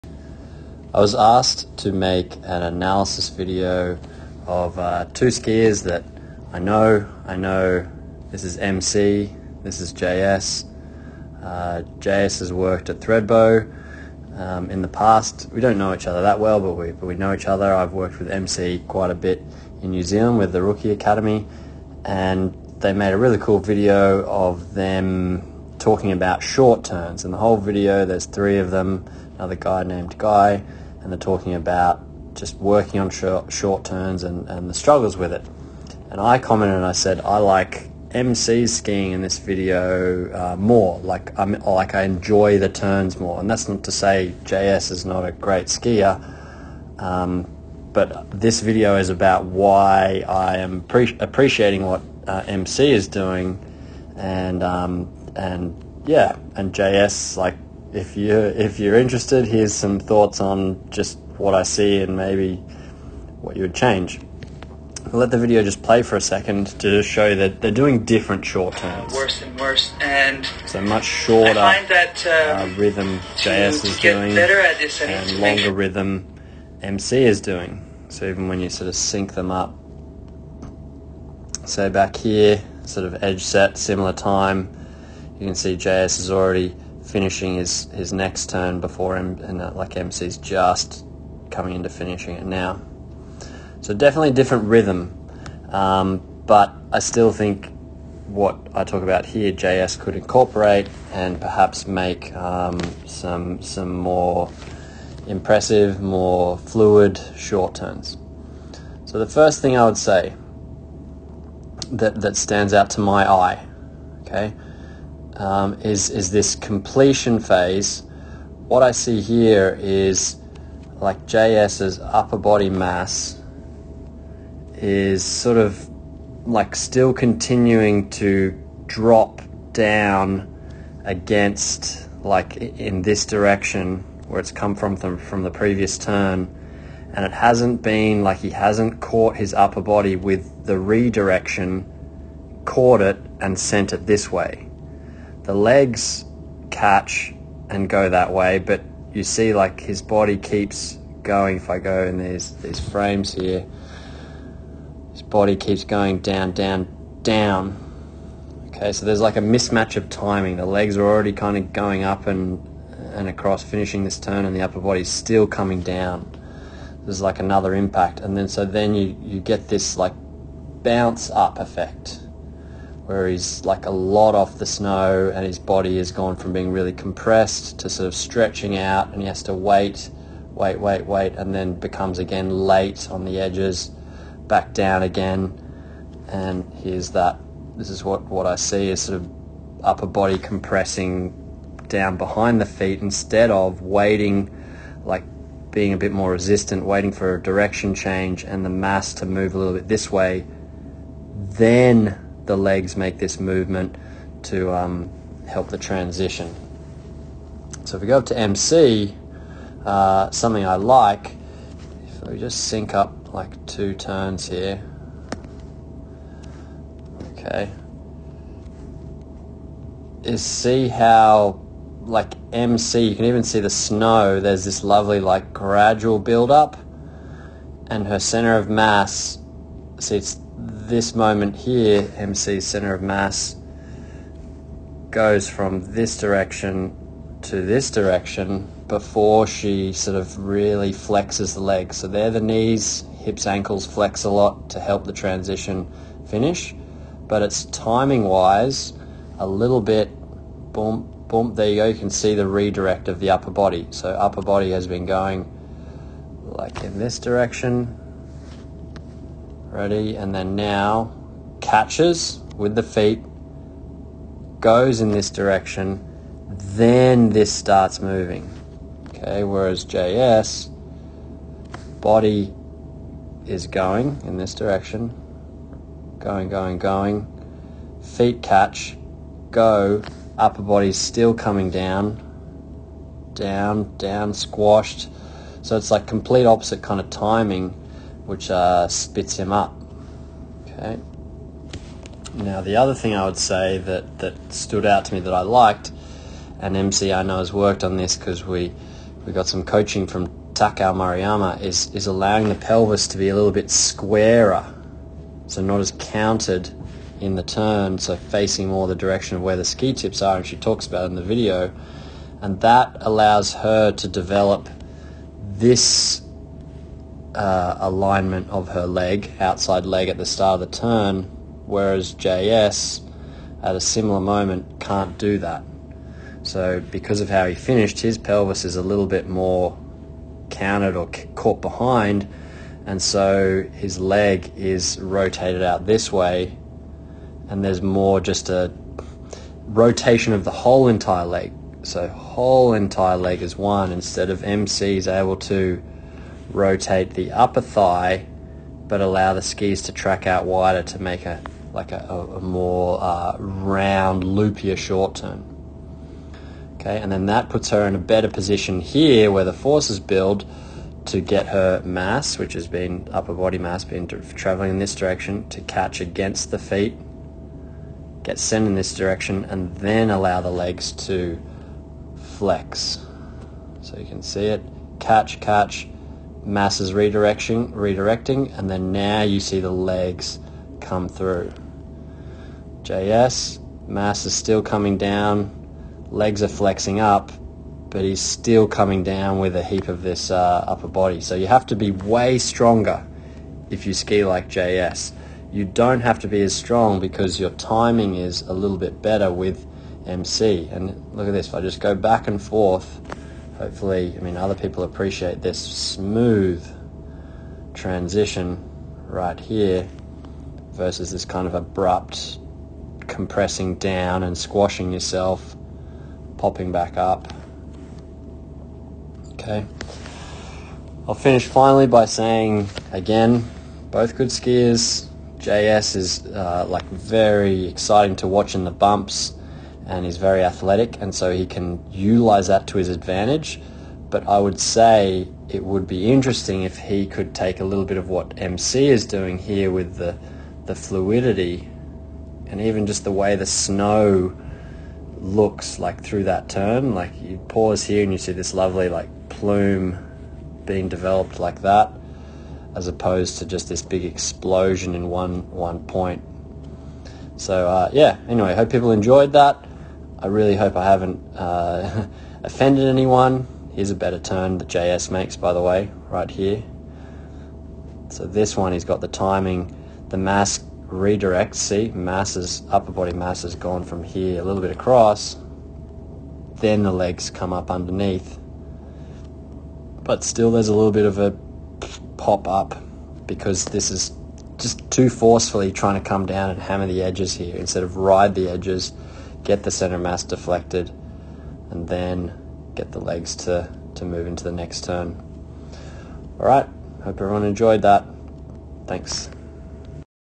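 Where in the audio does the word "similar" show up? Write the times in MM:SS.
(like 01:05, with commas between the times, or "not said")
01:23, 05:23.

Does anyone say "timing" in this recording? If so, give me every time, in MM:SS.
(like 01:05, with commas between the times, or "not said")
02:40, 04:07, 04:47, 06:37, 07:49.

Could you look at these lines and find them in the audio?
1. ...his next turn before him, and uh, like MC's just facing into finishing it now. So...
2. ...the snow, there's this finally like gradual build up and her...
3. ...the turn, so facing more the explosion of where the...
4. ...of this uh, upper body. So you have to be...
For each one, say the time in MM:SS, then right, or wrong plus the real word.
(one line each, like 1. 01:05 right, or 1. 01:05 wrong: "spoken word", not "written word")
1. 01:27 wrong: "coming", not "facing"
2. 03:43 wrong: "lovely", not "finally"
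3. 05:07 wrong: "direction", not "explosion"
4. 06:29 right.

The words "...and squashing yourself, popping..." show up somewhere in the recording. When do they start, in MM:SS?
06:54.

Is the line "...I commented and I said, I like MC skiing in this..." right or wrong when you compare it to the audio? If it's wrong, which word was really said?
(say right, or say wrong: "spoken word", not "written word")
right.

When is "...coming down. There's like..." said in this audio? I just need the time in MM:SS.
02:45.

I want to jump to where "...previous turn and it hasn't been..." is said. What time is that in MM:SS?
02:15.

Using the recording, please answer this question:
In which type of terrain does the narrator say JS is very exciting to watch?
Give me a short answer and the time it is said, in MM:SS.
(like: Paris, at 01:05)
the bumps, at 07:08.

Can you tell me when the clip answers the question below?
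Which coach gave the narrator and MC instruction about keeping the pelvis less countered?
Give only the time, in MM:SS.
05:00.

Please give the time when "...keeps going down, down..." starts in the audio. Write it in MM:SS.
02:35.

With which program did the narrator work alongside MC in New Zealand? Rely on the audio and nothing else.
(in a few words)
Rookie Academy.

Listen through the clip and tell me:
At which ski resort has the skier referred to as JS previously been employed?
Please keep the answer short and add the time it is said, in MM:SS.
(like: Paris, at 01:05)
Thredbo, at 00:12.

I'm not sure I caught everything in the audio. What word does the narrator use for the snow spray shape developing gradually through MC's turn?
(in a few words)
plume.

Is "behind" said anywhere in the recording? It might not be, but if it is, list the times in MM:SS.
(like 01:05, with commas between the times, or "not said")
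03:12, 05:31.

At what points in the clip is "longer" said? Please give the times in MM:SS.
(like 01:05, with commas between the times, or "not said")
01:15.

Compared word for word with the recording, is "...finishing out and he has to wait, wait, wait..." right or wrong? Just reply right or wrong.
wrong.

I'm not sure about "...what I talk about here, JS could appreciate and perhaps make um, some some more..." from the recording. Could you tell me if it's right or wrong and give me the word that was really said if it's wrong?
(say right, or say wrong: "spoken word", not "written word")
wrong: "incorporate", not "appreciate".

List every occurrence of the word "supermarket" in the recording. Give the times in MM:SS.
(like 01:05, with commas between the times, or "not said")
not said.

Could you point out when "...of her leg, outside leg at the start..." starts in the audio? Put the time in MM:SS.
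05:18.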